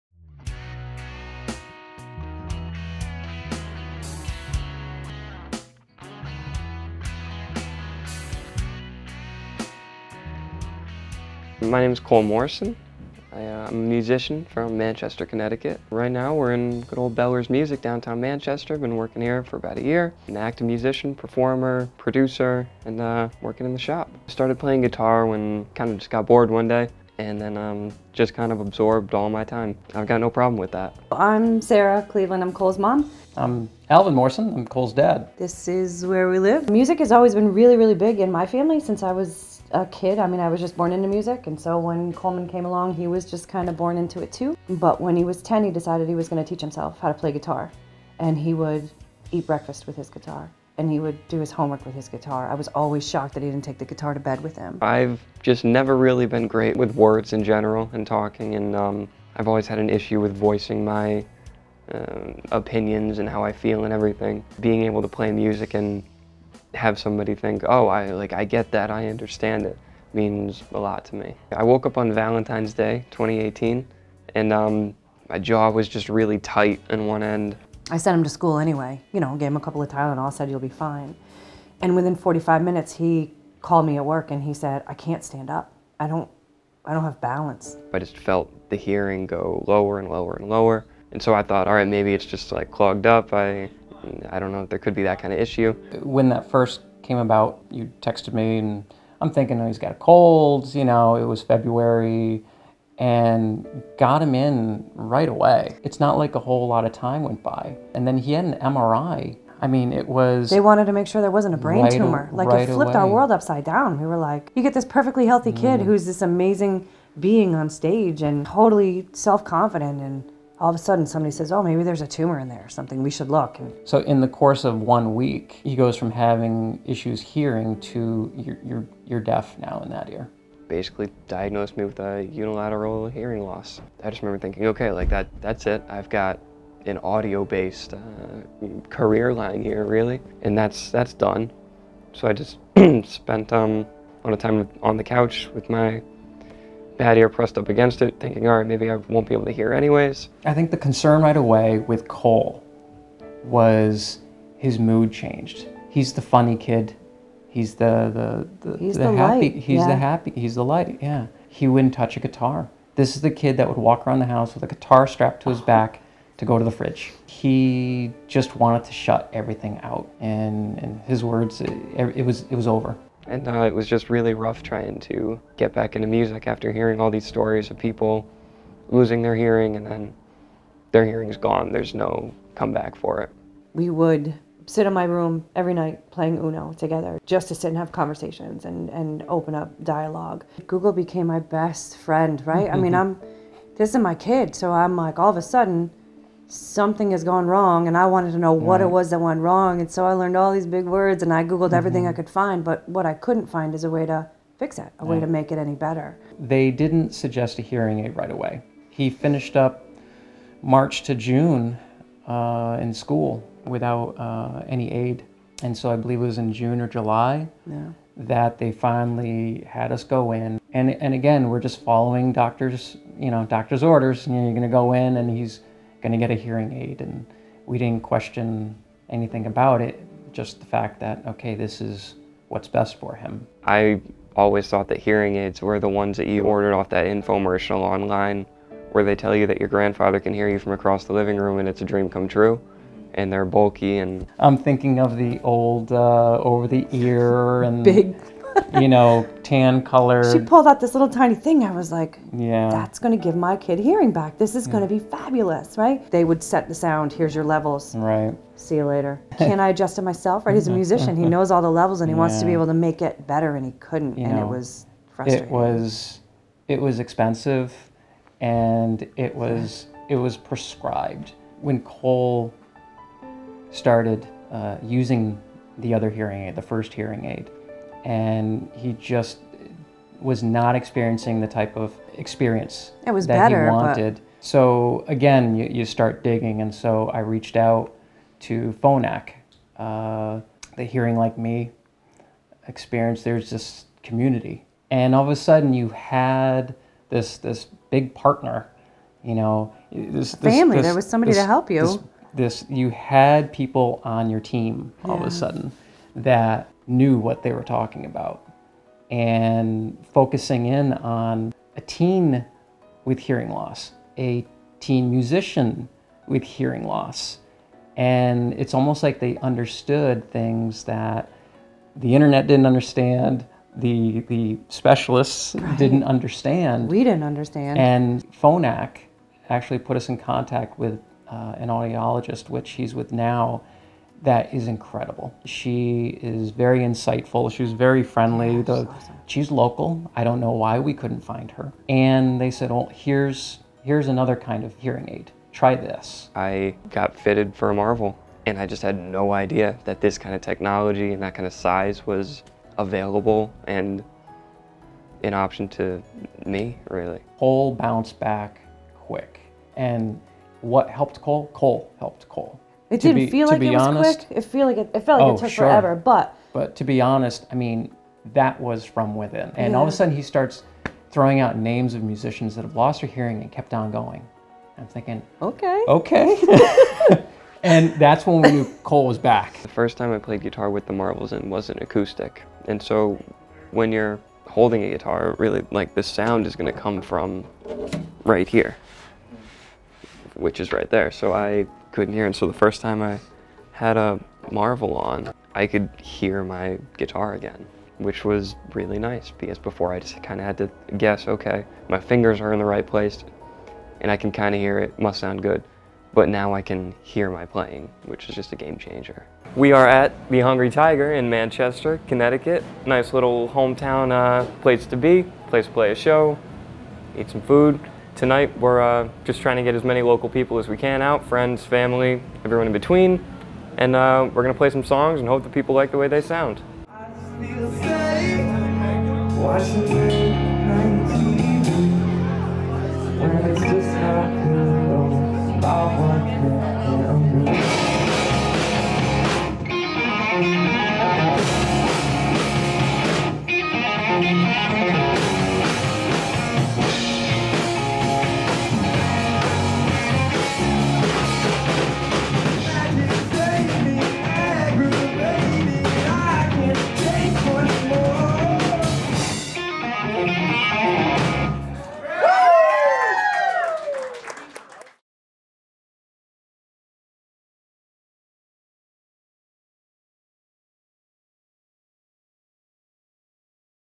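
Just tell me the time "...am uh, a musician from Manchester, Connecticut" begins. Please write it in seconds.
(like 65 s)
13 s.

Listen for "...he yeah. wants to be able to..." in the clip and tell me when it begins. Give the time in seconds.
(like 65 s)
262 s.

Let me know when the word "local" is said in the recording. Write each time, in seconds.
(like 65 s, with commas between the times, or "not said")
339 s, 420 s.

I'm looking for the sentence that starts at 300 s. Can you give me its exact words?
This, there was somebody this, to help you.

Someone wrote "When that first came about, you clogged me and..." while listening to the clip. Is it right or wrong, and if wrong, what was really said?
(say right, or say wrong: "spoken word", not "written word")
wrong: "texted", not "clogged".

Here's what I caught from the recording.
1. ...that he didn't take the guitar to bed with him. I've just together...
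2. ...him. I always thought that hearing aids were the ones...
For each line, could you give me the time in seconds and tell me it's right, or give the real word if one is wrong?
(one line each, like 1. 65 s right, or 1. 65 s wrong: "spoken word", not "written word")
1. 53 s wrong: "never", not "together"
2. 233 s right.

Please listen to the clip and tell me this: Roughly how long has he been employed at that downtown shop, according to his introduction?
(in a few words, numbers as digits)
about a year.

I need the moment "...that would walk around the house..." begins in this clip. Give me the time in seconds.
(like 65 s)
163 s.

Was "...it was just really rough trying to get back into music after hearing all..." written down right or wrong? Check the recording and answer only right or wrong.
right.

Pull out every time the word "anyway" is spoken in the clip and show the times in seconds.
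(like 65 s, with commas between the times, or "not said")
78 s, 149 s.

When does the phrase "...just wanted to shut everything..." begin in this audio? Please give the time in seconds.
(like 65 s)
168 s.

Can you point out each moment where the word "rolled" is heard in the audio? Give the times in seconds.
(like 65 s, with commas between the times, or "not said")
not said.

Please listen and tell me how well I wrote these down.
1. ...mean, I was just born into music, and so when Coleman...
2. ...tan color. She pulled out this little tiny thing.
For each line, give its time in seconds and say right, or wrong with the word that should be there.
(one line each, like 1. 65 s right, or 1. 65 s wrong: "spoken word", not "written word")
1. 40 s right
2. 249 s right.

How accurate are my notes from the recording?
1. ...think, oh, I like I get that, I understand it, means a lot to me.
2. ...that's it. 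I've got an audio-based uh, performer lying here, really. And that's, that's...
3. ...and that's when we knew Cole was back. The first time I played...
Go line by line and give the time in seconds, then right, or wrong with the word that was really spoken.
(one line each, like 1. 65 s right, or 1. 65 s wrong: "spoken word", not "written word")
1. 67 s right
2. 135 s wrong: "career", not "performer"
3. 377 s right.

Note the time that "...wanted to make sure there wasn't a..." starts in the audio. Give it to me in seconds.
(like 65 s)
110 s.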